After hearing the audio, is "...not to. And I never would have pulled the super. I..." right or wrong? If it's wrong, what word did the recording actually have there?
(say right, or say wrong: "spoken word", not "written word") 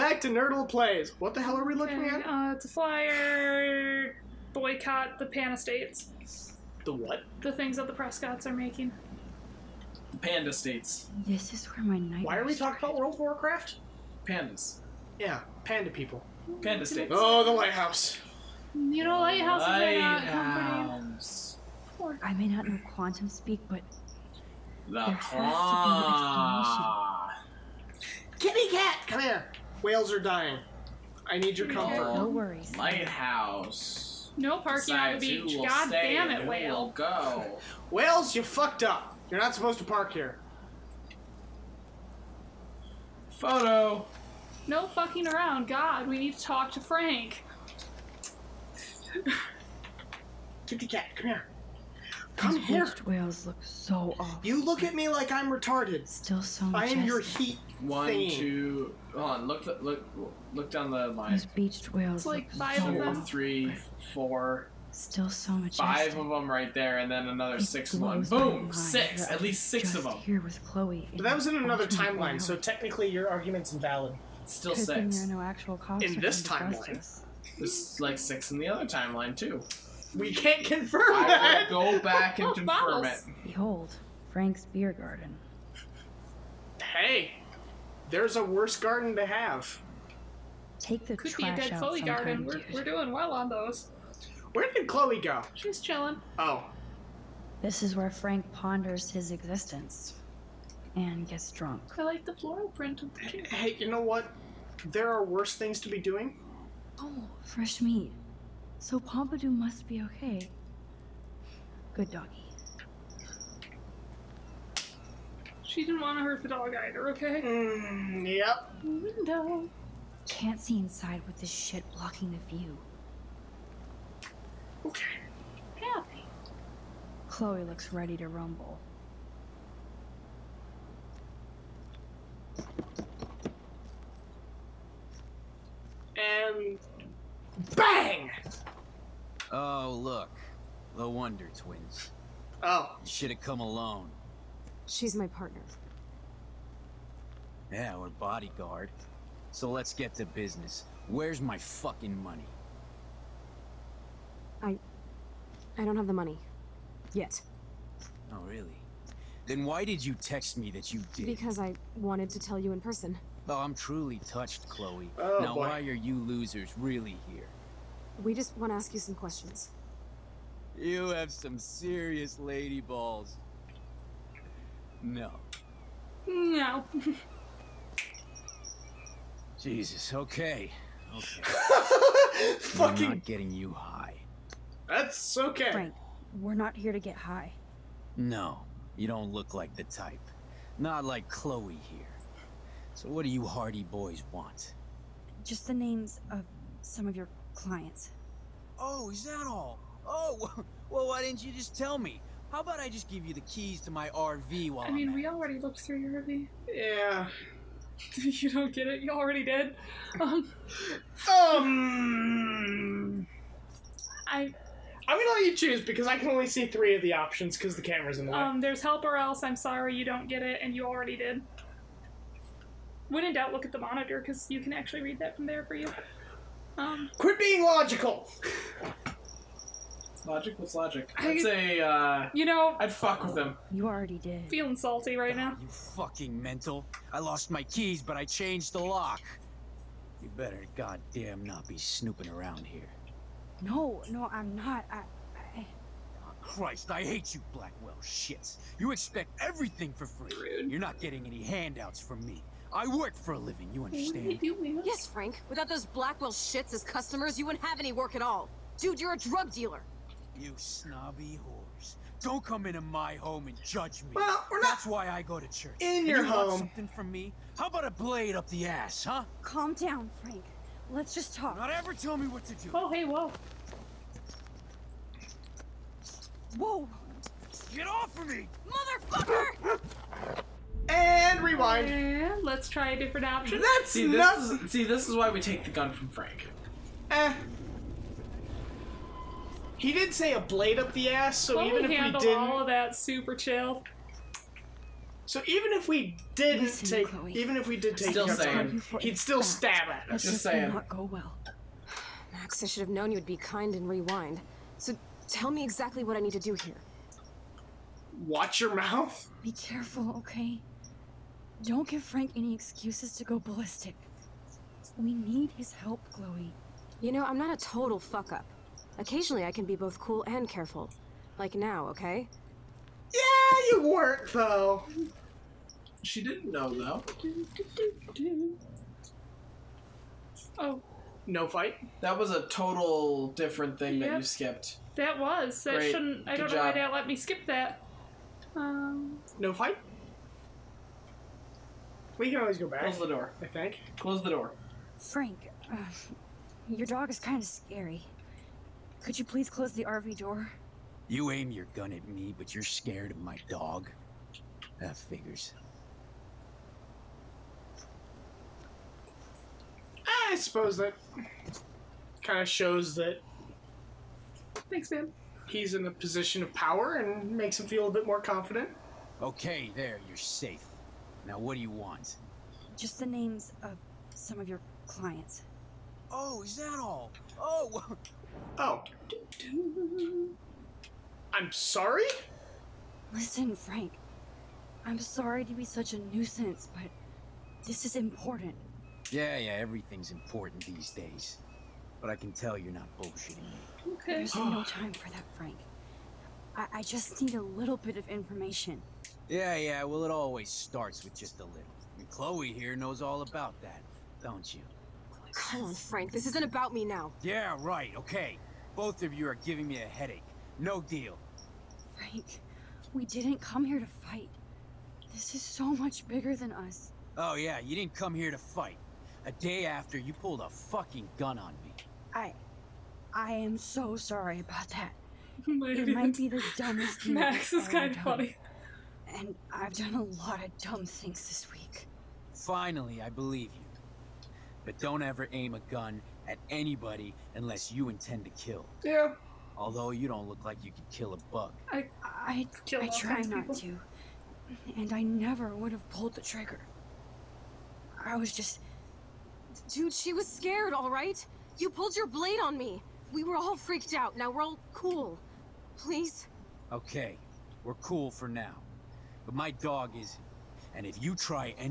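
wrong: "trigger", not "super".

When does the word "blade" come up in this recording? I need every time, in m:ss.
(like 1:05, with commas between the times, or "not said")
4:27, 4:50, 7:32.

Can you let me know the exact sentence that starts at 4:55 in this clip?
So even if we didn't Listen, take, Chloe.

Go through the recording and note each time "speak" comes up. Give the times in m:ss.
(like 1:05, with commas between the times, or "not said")
0:23.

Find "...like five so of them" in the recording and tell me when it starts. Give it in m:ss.
1:02.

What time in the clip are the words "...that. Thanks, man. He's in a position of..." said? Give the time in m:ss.
6:02.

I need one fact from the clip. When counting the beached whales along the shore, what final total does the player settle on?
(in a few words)
6.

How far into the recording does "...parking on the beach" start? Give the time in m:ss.
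0:34.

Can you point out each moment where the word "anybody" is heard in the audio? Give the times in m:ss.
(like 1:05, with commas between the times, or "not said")
7:16.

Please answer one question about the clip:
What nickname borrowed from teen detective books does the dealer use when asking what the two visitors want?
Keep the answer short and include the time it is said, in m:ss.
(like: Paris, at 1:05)
hardy boys, at 3:13.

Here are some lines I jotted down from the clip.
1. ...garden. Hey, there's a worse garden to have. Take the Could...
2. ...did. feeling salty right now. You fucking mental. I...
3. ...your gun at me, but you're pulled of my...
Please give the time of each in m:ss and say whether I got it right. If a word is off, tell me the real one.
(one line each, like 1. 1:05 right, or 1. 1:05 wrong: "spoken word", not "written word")
1. 1:24 right
2. 3:54 right
3. 5:51 wrong: "scared", not "pulled".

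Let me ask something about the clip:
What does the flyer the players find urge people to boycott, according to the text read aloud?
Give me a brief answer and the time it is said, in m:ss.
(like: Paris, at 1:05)
Pan Estates, at 0:05.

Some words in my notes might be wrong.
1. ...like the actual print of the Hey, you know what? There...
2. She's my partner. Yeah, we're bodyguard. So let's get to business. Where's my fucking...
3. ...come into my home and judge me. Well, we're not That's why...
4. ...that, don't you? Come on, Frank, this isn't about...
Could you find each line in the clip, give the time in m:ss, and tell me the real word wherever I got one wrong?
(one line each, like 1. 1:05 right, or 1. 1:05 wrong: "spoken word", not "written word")
1. 1:42 wrong: "floral", not "actual"
2. 2:24 right
3. 4:22 right
4. 6:43 right.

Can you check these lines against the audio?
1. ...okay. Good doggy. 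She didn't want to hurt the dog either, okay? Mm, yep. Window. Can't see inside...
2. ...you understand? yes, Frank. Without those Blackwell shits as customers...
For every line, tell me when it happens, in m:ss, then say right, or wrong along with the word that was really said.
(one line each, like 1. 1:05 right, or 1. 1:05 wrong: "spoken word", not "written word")
1. 1:50 right
2. 4:13 right.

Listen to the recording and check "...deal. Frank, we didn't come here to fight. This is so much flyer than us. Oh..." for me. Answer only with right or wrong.
wrong.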